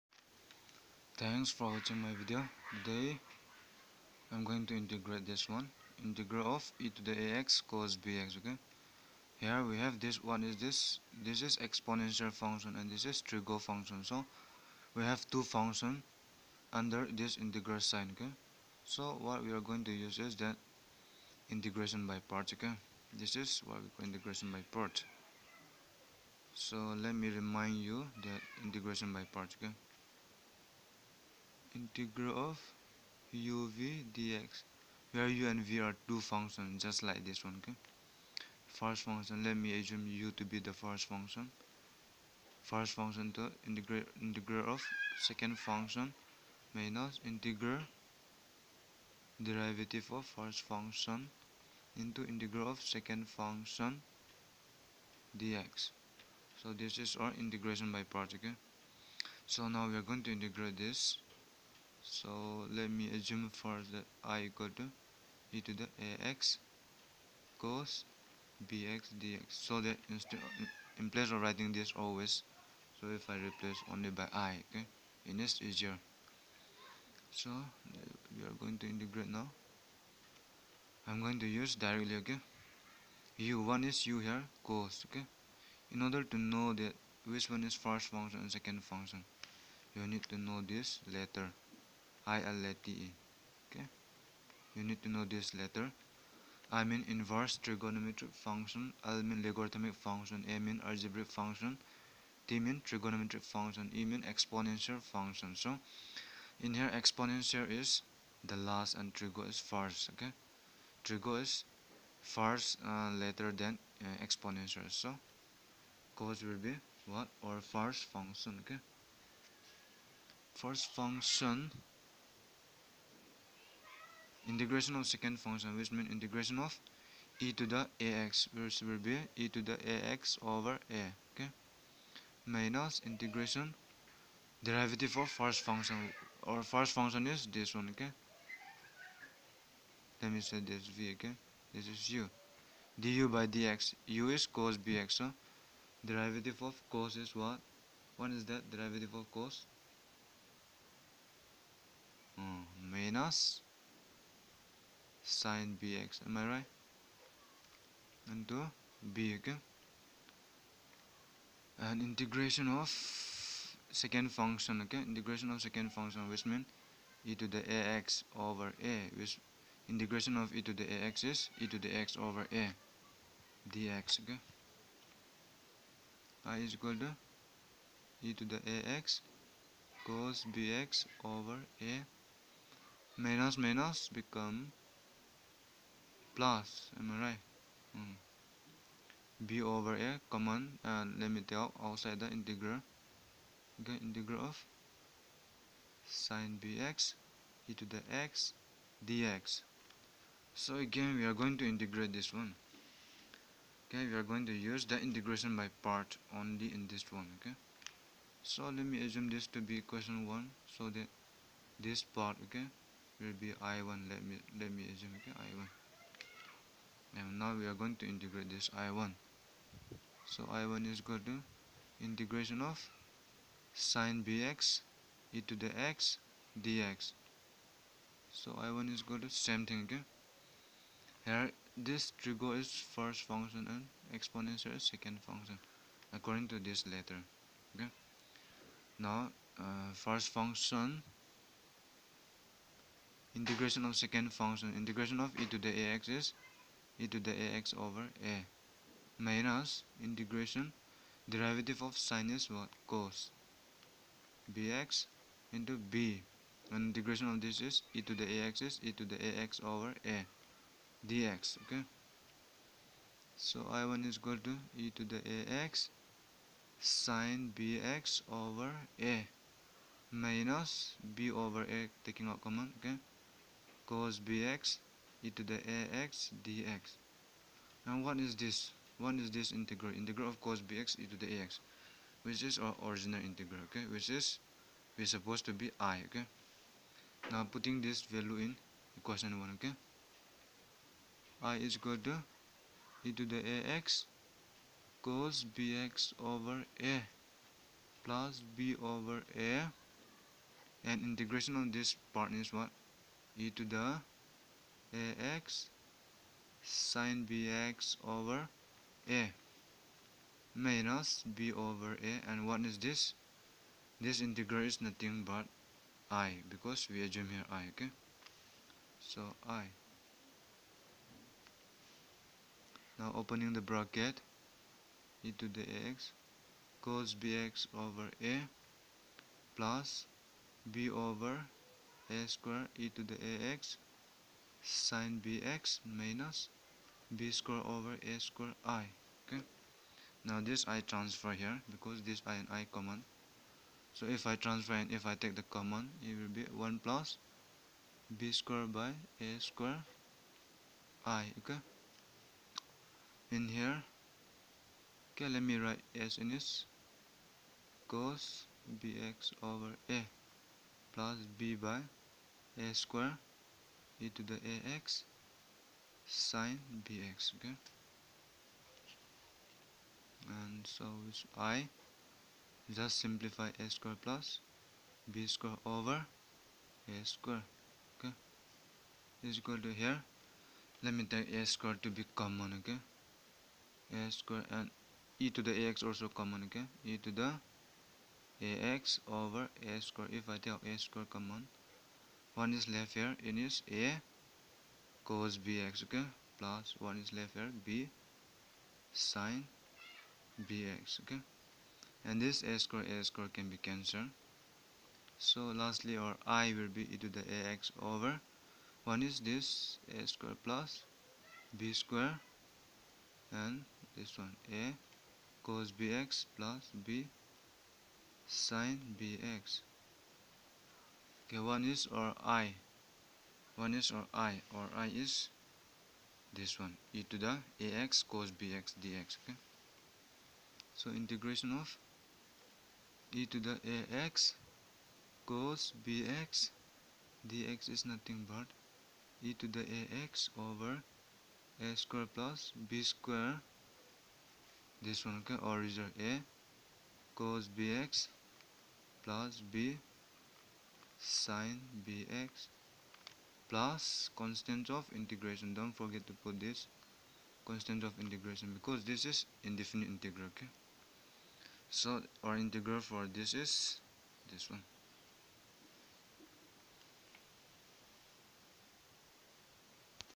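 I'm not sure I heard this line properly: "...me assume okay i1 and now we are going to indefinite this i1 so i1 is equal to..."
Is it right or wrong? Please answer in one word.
wrong.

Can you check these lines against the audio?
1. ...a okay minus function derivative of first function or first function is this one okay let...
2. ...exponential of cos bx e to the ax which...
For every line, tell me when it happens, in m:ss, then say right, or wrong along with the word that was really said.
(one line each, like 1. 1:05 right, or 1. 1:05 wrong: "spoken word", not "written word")
1. 2:10 wrong: "integration", not "function"
2. 4:39 wrong: "integral", not "exponential".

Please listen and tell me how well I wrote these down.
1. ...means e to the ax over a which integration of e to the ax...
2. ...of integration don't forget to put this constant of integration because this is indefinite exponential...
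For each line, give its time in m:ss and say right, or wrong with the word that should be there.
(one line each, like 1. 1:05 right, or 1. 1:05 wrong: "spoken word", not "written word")
1. 2:46 right
2. 7:34 wrong: "integral", not "exponential".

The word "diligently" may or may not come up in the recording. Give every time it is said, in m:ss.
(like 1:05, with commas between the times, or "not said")
not said.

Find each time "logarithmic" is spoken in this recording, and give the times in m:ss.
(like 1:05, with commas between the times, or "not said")
1:39.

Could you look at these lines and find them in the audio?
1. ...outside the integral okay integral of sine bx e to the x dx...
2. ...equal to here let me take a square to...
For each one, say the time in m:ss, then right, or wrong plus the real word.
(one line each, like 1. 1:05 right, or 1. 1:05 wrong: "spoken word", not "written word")
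1. 3:11 right
2. 6:19 right.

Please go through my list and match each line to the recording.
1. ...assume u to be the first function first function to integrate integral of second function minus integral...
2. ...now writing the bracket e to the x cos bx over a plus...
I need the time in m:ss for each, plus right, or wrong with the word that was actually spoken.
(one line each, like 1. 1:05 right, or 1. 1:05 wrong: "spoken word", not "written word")
1. 0:39 right
2. 5:22 wrong: "opening", not "writing".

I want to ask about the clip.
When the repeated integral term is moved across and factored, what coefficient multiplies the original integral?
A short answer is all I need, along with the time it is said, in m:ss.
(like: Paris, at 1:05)
1 plus b²/a², at 5:46.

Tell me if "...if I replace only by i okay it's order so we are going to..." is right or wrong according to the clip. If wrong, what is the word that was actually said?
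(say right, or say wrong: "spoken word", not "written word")
wrong: "easier", not "order".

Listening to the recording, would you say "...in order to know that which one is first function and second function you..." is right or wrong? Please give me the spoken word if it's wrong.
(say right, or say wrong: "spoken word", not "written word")
right.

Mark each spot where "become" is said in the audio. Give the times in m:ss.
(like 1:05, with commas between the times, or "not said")
3:04.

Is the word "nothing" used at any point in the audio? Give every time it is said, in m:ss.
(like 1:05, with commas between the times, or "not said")
5:14, 7:17.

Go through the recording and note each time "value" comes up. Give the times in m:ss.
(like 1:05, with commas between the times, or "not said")
4:48.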